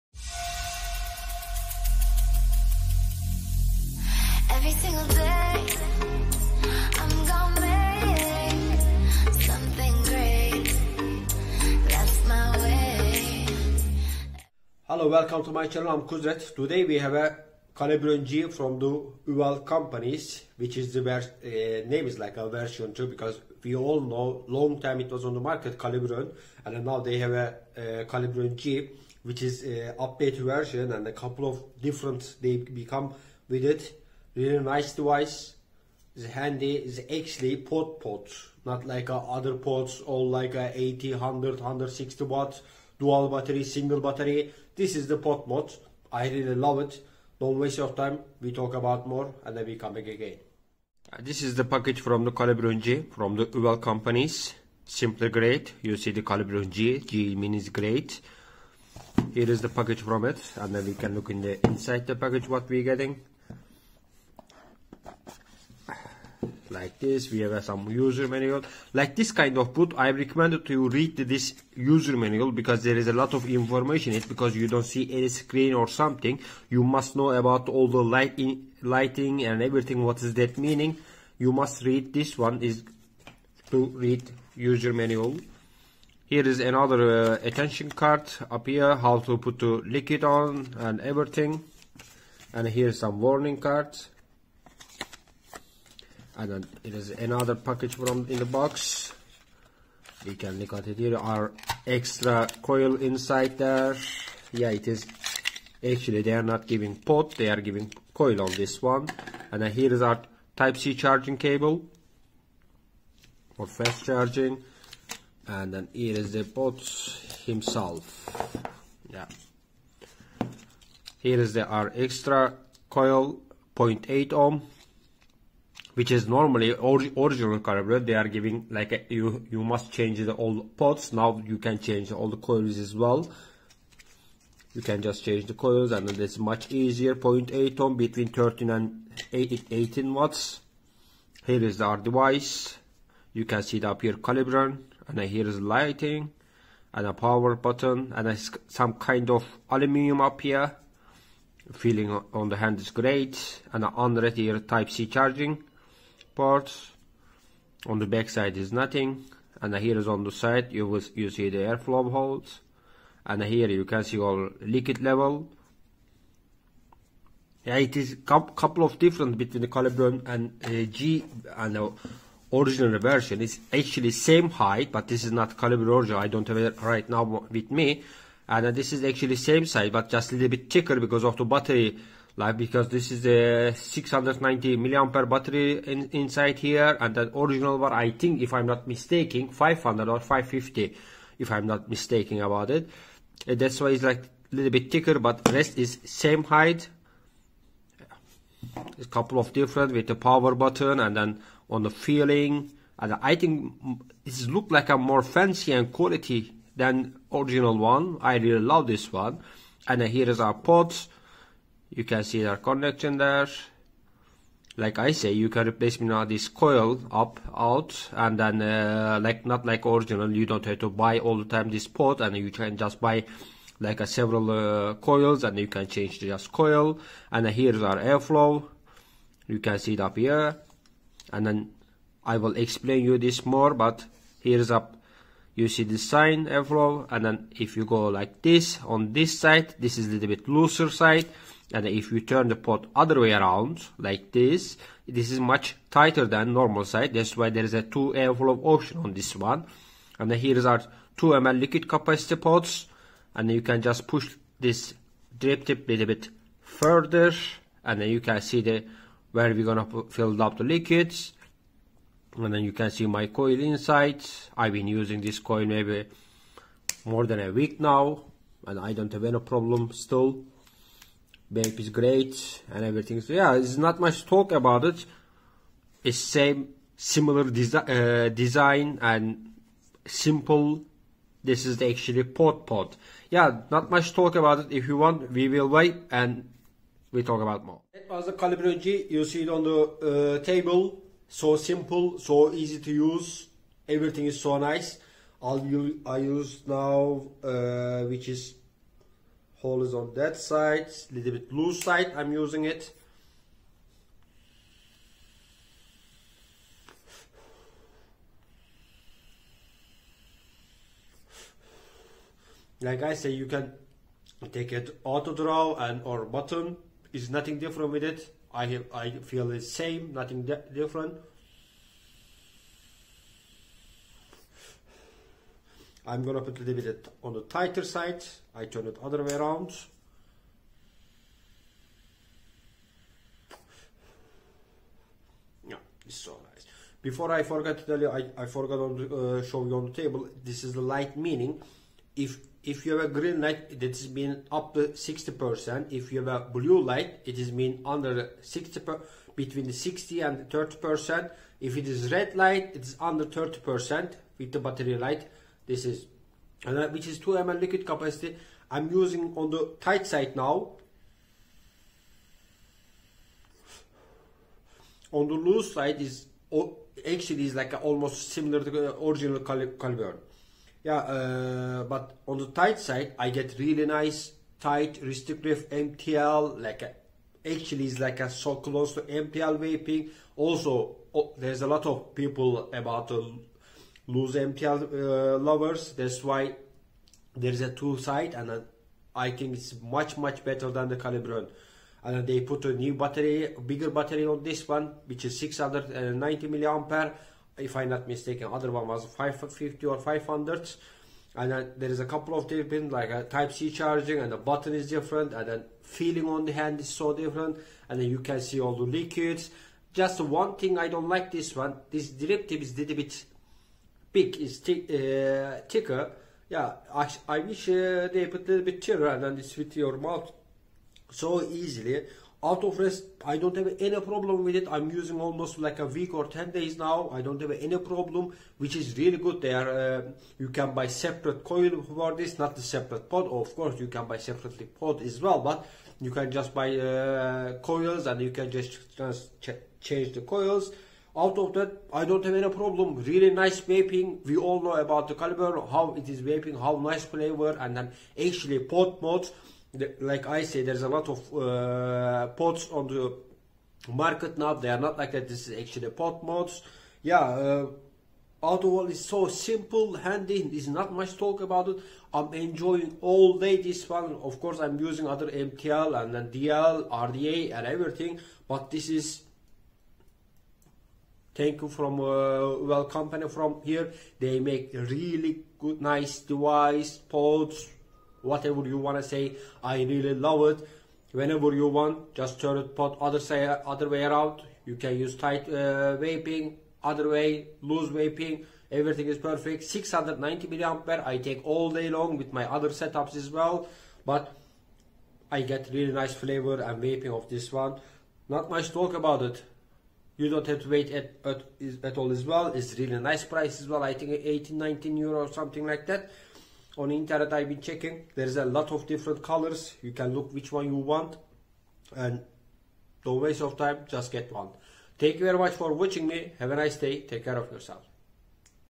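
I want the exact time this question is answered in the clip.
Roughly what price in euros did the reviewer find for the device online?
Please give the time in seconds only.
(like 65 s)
504 s.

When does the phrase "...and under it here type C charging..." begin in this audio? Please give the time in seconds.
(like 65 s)
153 s.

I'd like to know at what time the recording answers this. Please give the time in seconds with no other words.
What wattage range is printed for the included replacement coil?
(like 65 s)
137 s.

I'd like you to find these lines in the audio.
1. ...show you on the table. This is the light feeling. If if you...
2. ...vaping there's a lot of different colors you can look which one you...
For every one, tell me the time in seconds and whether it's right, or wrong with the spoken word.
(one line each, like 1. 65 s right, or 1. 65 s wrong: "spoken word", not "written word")
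1. 339 s wrong: "meaning", not "feeling"
2. 507 s wrong: "checking", not "vaping".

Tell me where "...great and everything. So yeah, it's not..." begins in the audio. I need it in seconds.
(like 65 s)
271 s.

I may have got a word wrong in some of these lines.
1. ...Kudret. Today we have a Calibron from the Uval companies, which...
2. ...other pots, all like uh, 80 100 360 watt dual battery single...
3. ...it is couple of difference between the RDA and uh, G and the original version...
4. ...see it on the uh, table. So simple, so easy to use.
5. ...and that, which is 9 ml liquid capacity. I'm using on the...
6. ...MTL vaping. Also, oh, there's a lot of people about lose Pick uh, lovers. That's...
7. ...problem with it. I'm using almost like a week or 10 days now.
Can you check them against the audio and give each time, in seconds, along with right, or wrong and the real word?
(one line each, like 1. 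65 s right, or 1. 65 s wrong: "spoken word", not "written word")
1. 16 s right
2. 39 s wrong: "160", not "360"
3. 167 s wrong: "Caliburn", not "RDA"
4. 289 s right
5. 356 s wrong: "2", not "9"
6. 379 s wrong: "MTL", not "Pick"
7. 424 s right.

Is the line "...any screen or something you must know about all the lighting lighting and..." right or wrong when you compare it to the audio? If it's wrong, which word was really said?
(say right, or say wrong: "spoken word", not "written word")
right.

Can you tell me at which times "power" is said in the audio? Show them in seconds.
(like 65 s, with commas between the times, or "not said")
147 s, 200 s.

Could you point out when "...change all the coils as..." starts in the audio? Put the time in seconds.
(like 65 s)
131 s.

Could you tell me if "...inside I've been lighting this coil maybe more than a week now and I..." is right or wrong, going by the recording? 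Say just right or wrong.
wrong.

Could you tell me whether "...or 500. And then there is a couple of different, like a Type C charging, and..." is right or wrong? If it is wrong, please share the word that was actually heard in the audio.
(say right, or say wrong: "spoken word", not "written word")
right.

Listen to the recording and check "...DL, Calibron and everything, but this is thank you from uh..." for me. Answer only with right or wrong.
wrong.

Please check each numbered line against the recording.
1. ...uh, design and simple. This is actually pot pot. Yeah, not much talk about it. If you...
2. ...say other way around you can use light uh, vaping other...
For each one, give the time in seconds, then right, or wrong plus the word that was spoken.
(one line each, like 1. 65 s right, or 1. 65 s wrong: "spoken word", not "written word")
1. 277 s right
2. 483 s wrong: "tight", not "light".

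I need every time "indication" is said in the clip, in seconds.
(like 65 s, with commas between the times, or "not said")
not said.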